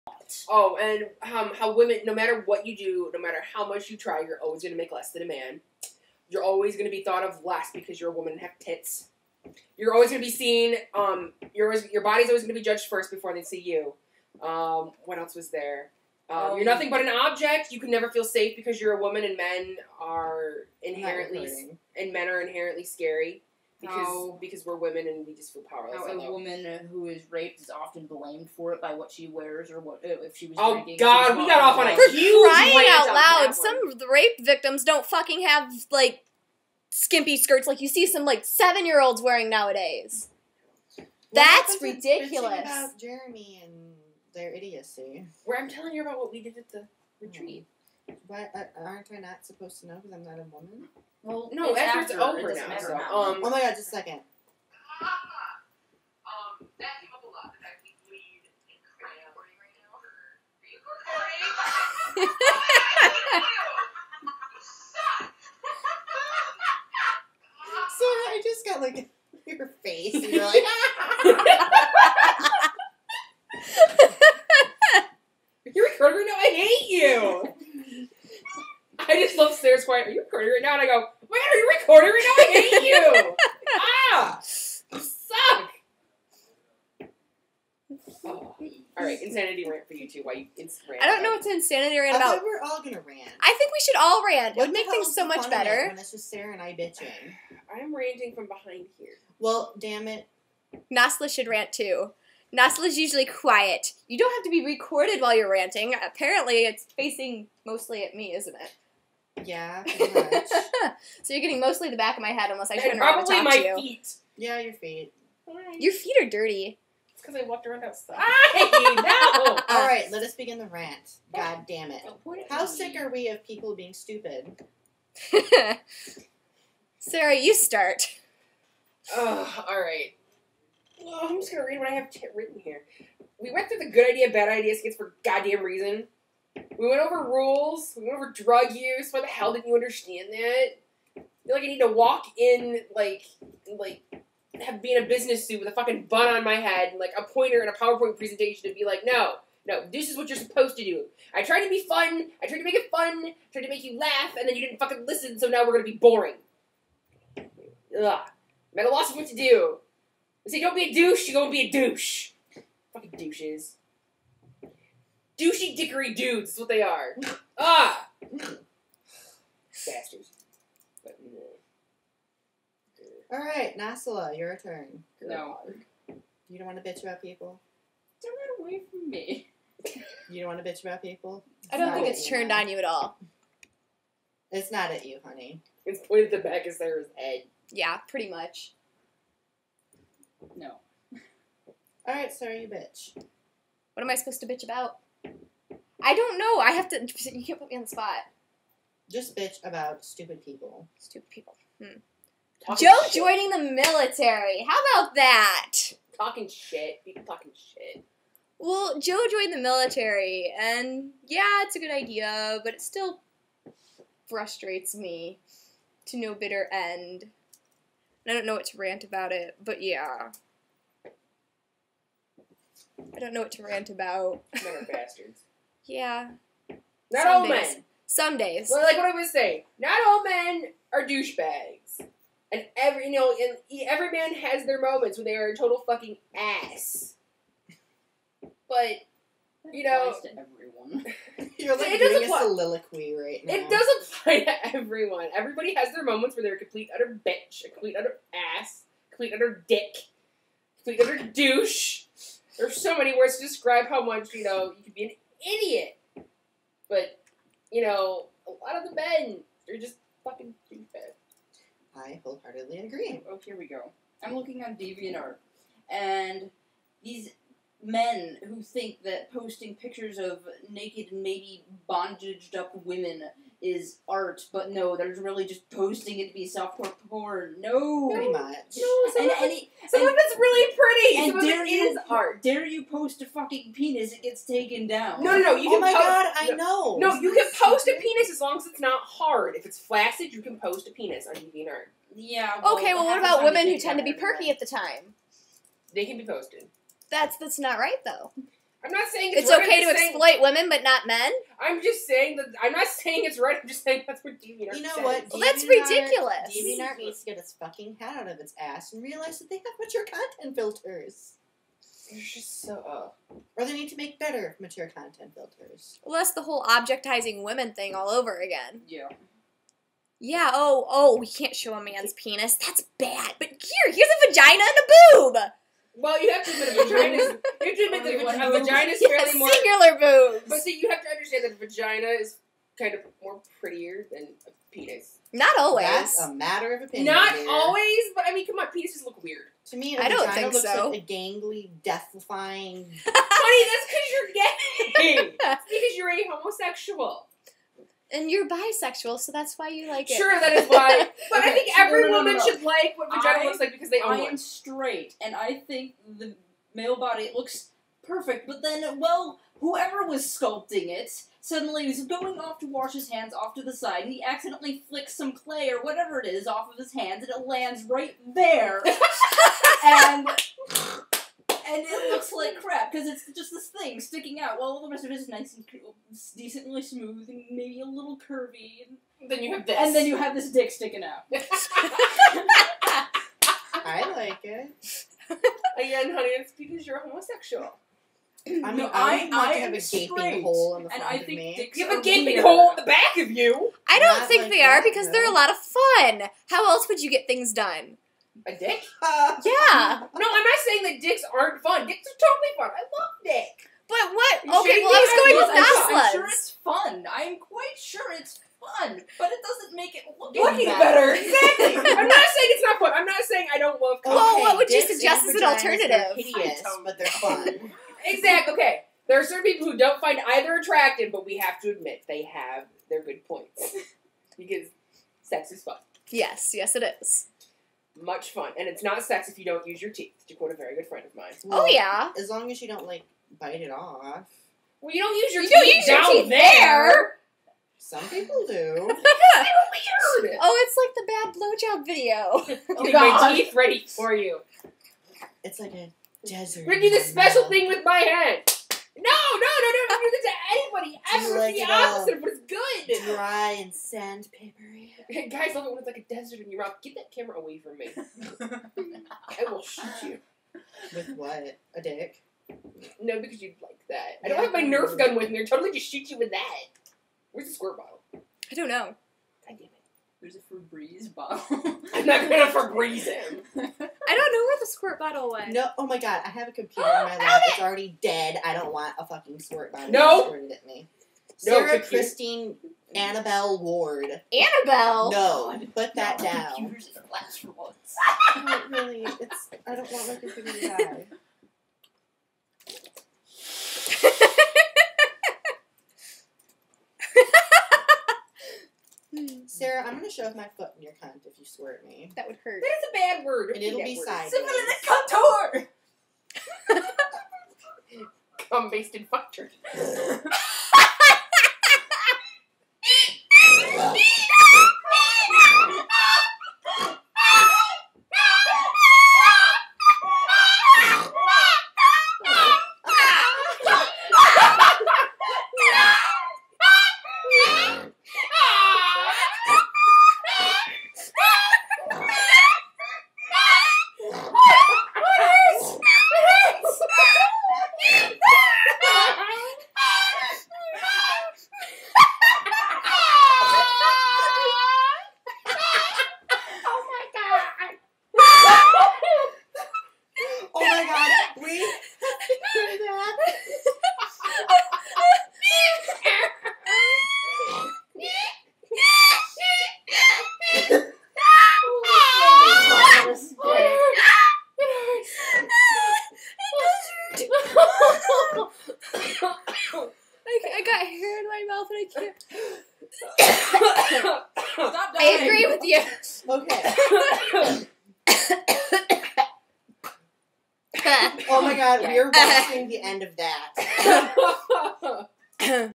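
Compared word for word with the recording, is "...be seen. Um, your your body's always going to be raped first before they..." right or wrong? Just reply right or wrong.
wrong.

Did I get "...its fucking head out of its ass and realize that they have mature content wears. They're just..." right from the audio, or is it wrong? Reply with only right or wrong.
wrong.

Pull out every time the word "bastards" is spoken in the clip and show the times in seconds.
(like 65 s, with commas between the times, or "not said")
169 s, 224 s.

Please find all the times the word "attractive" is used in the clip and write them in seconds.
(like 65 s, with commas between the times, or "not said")
420 s.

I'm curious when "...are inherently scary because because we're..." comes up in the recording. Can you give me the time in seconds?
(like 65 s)
22 s.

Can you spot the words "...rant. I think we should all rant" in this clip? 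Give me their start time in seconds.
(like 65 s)
93 s.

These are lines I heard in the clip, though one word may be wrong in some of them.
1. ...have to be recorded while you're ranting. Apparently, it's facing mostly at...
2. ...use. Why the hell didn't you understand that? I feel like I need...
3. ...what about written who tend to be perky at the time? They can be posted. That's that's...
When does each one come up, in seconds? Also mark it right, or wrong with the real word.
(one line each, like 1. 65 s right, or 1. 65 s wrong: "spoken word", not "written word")
1. 104 s right
2. 138 s right
3. 293 s wrong: "women", not "written".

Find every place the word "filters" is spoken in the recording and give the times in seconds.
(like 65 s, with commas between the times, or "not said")
310 s, 315 s.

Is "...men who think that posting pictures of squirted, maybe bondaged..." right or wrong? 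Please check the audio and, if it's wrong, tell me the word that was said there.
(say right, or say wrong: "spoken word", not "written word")
wrong: "naked", not "squirted".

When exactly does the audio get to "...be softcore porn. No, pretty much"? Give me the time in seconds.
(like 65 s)
276 s.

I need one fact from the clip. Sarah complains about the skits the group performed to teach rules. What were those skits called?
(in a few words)
good idea, bad idea.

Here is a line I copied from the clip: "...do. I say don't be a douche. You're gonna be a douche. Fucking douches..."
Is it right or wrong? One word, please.
right.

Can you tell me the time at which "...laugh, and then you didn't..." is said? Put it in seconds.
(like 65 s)
153 s.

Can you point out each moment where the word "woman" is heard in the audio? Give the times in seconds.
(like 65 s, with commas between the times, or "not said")
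8 s, 19 s, 26 s, 50 s, 352 s.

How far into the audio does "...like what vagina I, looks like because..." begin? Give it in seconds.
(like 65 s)
352 s.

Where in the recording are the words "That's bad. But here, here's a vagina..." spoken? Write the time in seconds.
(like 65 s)
322 s.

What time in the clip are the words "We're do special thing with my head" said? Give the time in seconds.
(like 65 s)
446 s.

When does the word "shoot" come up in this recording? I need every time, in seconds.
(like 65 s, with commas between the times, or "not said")
459 s, 465 s.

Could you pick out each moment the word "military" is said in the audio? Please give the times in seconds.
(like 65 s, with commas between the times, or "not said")
203 s, 209 s.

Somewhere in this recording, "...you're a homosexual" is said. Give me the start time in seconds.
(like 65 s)
345 s.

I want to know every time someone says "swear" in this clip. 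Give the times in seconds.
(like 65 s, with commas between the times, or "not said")
501 s.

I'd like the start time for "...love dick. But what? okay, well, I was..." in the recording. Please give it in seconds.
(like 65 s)
402 s.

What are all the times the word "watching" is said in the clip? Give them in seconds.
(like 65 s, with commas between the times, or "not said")
582 s.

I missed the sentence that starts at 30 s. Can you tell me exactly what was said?
Oh God, we got off on a for huge crying out loud.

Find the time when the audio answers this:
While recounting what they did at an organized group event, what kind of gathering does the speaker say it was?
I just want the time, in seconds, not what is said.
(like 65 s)
47 s.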